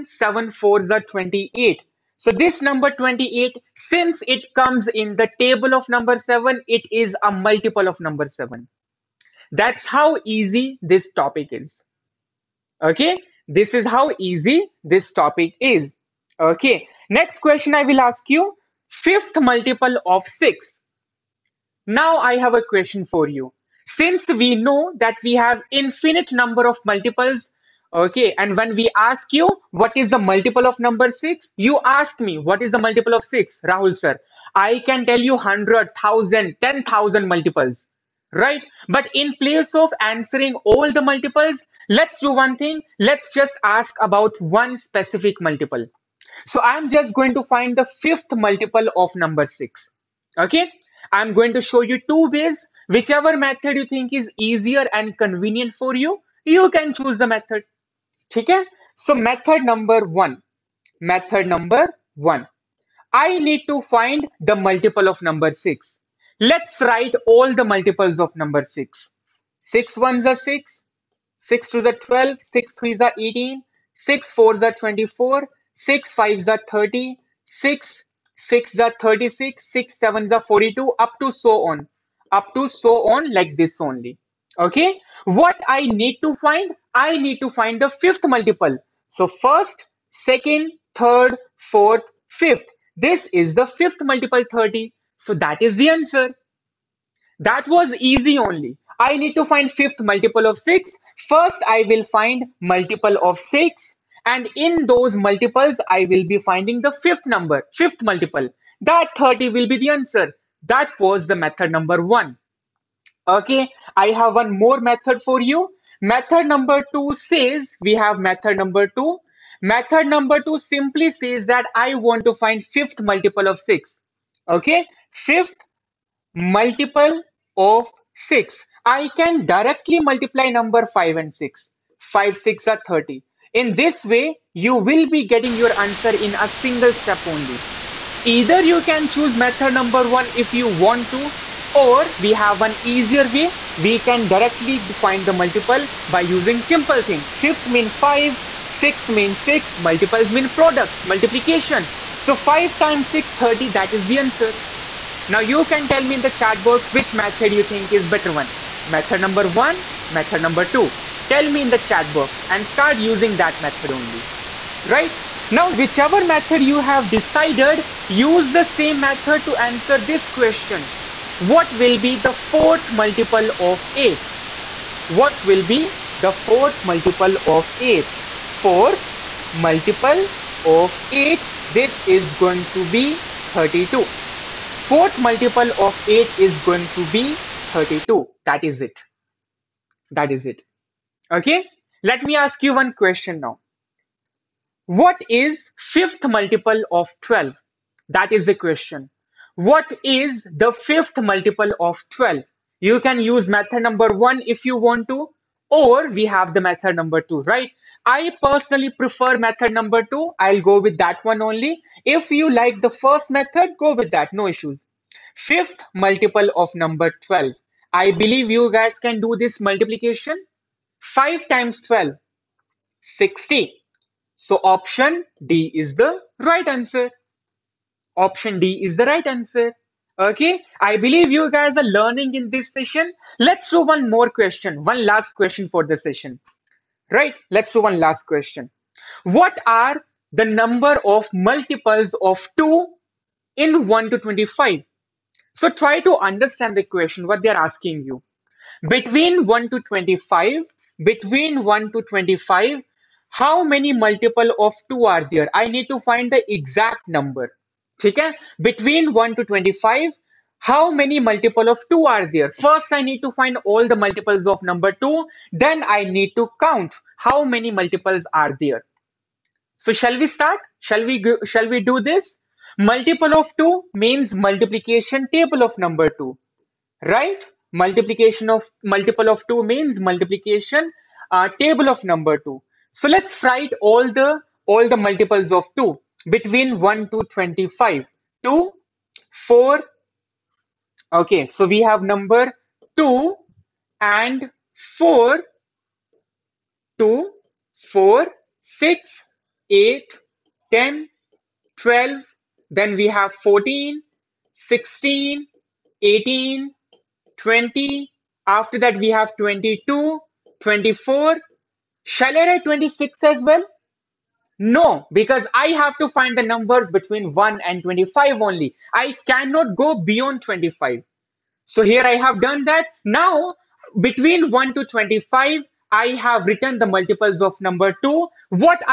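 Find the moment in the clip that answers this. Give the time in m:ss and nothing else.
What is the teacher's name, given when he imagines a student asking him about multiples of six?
0:33.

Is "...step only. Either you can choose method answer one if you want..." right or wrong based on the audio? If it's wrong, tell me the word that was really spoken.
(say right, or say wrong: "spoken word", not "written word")
wrong: "number", not "answer".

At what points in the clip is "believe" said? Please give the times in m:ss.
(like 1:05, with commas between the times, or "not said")
3:38, 3:50.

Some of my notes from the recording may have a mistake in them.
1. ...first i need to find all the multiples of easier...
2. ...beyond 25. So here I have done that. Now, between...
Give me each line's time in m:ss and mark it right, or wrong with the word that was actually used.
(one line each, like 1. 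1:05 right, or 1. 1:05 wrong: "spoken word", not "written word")
1. 4:22 wrong: "number", not "easier"
2. 5:20 right.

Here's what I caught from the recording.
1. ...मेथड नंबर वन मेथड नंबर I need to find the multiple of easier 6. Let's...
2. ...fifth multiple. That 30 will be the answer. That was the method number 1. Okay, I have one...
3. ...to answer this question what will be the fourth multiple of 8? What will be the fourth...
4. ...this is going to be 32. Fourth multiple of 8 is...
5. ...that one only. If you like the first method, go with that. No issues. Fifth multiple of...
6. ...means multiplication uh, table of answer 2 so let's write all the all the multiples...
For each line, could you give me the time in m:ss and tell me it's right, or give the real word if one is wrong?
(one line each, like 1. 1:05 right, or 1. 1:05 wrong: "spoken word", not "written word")
1. 0:59 wrong: "number", not "easier"
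2. 1:47 right
3. 2:49 right
4. 3:01 right
5. 3:30 right
6. 4:39 wrong: "number", not "answer".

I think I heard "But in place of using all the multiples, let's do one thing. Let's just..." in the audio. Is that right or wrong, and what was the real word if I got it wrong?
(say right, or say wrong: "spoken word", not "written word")
wrong: "answering", not "using".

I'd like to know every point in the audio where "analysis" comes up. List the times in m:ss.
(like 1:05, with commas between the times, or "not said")
not said.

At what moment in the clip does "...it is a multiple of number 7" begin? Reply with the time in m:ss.
0:06.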